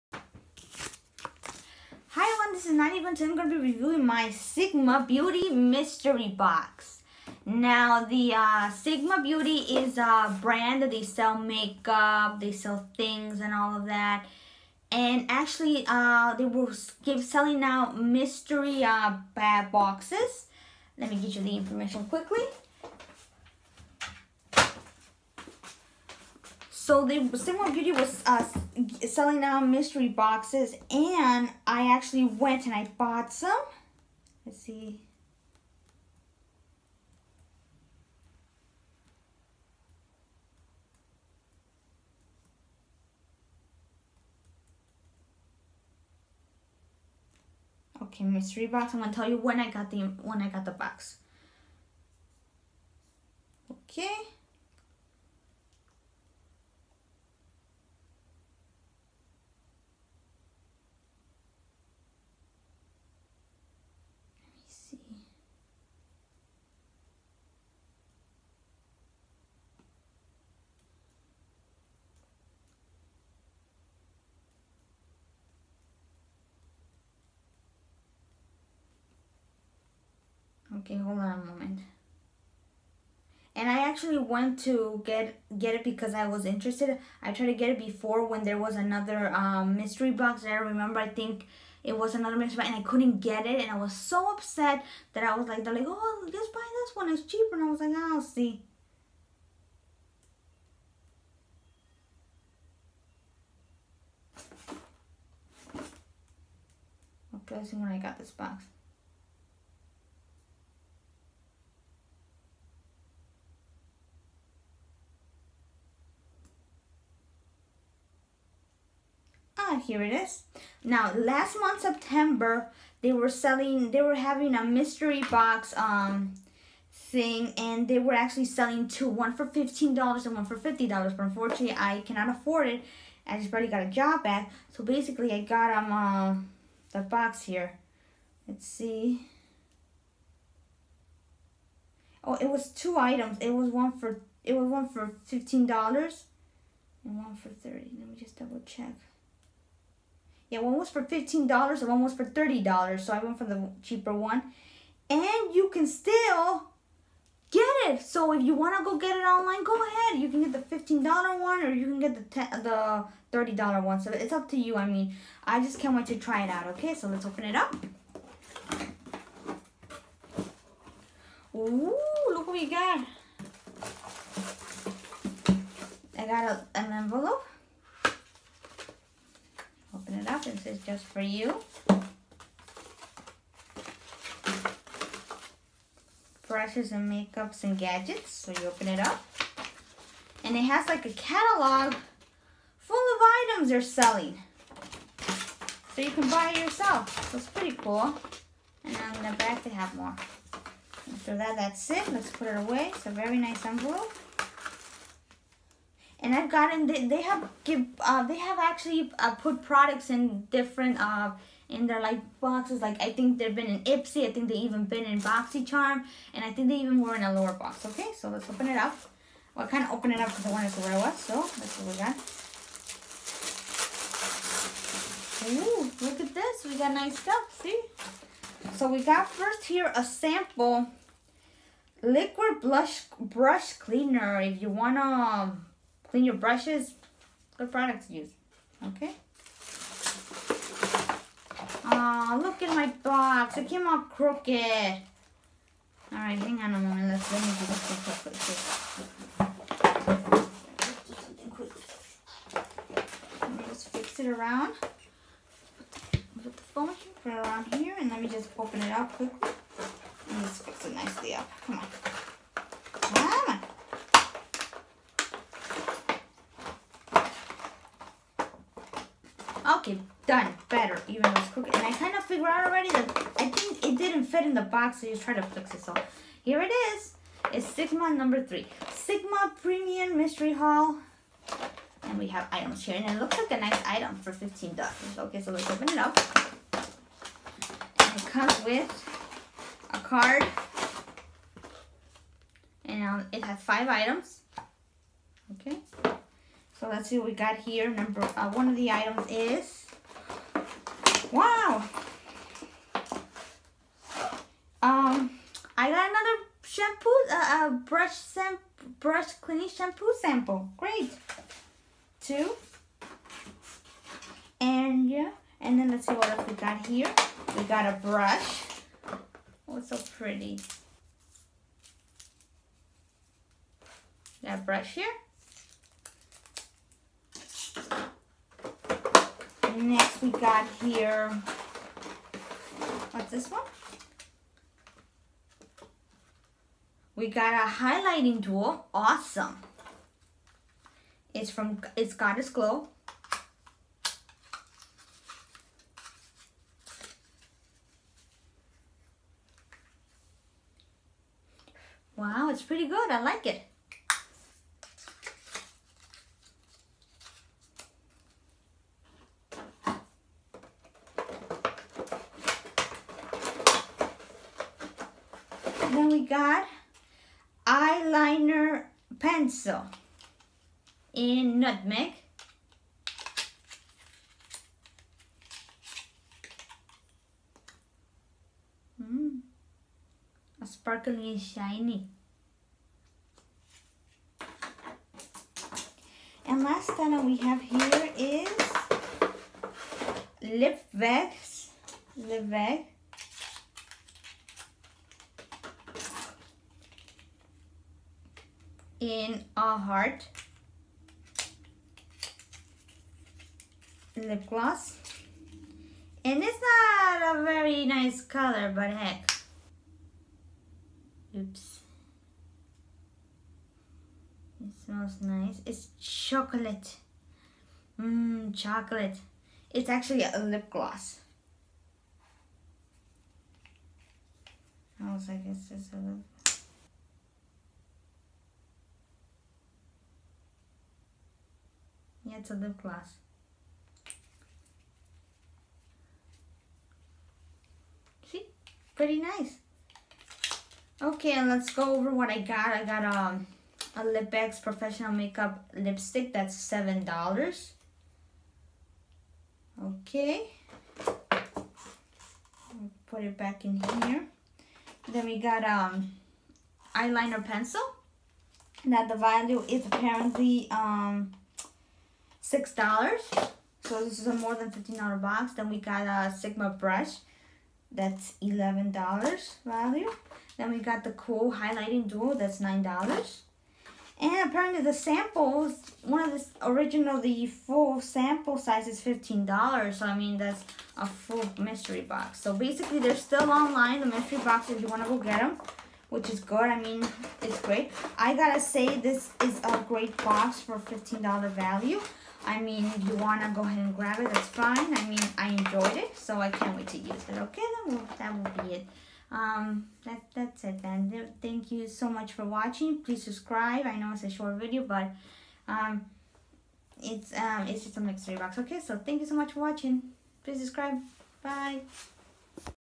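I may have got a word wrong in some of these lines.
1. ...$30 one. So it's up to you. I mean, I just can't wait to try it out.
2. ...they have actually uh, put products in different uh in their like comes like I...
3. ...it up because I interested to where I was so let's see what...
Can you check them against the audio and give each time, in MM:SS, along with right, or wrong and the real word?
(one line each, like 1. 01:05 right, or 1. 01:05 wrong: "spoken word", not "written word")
1. 02:43 right
2. 03:28 wrong: "boxes", not "comes"
3. 03:40 wrong: "wanted", not "interested".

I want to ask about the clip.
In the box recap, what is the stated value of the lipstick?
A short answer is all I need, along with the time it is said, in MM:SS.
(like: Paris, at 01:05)
$7, at 07:26.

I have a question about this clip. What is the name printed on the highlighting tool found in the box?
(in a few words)
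Goddess Glow.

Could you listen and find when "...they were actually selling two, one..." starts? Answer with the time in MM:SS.
02:07.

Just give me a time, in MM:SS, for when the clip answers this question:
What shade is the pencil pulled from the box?
06:11.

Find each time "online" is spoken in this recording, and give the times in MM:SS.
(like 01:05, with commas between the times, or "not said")
02:39, 08:03.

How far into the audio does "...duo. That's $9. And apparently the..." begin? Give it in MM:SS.
07:52.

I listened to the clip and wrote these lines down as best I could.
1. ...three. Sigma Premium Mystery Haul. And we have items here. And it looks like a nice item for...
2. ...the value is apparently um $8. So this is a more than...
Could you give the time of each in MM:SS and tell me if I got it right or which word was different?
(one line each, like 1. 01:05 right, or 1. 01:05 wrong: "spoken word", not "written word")
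1. 04:38 right
2. 07:39 wrong: "6", not "8".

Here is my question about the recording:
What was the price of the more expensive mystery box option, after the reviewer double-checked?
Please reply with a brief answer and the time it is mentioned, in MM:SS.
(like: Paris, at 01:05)
$30, at 02:31.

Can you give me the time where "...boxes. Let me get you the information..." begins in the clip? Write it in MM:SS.
00:19.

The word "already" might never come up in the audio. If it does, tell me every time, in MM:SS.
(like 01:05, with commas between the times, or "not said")
02:13, 04:32.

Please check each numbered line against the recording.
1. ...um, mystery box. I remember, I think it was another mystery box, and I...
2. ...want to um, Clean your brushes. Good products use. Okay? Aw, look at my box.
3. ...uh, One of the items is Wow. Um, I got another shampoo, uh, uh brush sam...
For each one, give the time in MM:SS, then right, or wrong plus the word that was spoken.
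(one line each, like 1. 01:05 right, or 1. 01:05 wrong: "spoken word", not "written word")
1. 01:29 right
2. 03:54 right
3. 04:58 right.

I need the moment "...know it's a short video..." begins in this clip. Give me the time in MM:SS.
08:23.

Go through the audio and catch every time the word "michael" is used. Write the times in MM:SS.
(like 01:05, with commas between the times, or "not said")
not said.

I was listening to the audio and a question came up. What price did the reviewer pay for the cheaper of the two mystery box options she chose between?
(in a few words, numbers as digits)
$15.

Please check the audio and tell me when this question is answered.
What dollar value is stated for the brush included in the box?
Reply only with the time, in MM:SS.
07:48.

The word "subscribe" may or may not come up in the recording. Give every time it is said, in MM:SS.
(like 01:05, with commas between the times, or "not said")
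08:23, 08:30.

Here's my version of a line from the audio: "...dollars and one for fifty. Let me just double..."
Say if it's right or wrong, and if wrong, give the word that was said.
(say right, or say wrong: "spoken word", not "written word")
wrong: "thirty", not "fifty".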